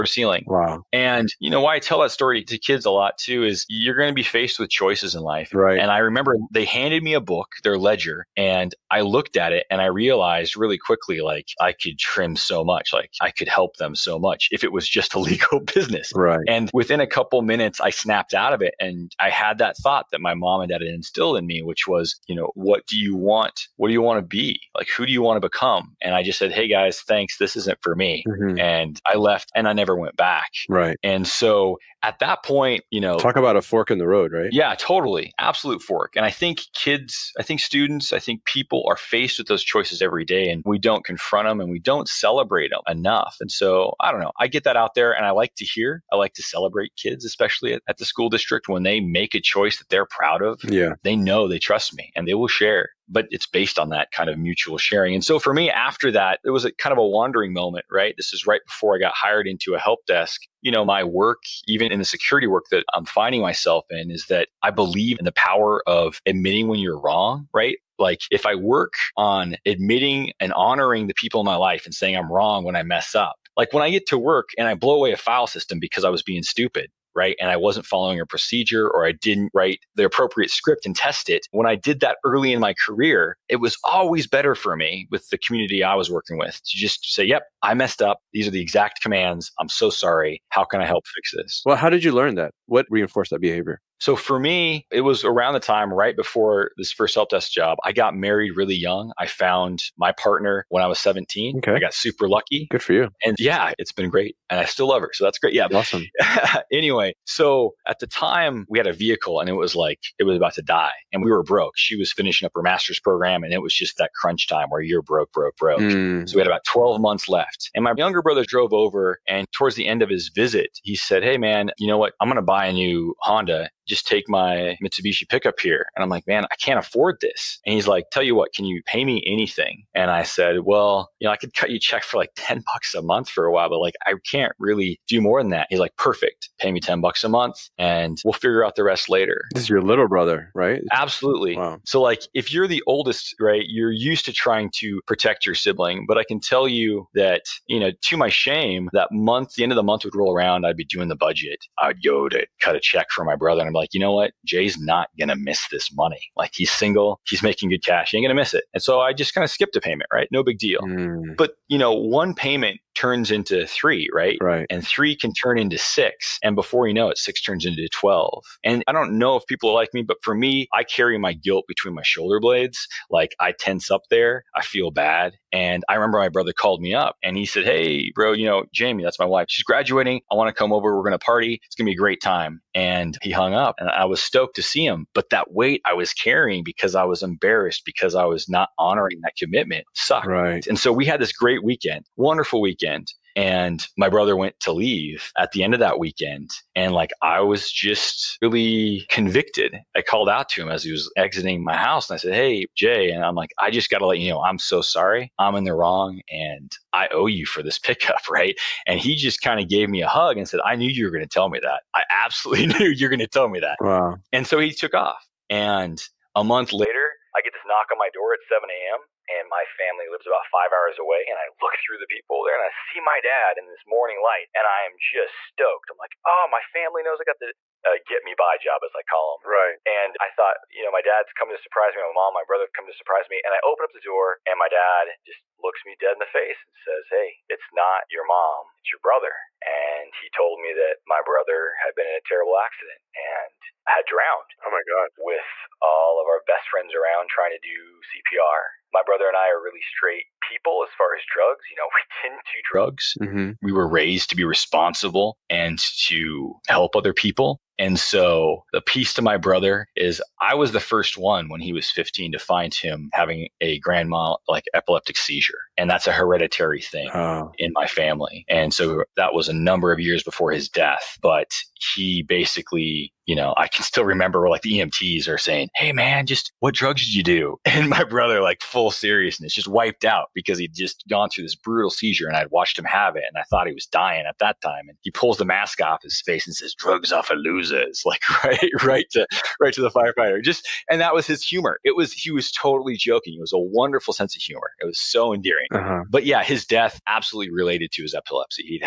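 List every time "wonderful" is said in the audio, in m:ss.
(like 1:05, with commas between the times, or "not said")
3:12, 4:53.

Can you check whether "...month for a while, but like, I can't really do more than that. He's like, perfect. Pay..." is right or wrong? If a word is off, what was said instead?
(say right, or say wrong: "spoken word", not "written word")
right.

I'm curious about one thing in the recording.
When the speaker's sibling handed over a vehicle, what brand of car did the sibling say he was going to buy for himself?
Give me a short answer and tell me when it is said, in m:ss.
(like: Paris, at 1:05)
Honda, at 2:03.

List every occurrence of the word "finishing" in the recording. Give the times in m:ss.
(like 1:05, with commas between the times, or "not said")
1:52.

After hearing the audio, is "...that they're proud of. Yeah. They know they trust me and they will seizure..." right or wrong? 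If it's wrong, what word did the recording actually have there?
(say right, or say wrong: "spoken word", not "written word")
wrong: "share", not "seizure".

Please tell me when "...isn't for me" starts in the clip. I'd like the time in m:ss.
0:27.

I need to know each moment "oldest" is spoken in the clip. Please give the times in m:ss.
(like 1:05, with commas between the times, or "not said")
2:22.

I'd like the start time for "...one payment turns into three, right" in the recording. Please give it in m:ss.
2:41.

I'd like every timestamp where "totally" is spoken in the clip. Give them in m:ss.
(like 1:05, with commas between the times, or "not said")
0:34, 4:52.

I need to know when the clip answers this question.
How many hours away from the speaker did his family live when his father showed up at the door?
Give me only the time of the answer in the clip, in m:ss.
3:40.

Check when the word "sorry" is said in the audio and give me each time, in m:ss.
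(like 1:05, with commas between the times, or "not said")
1:29, 3:24.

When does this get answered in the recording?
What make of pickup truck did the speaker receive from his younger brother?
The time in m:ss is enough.
2:04.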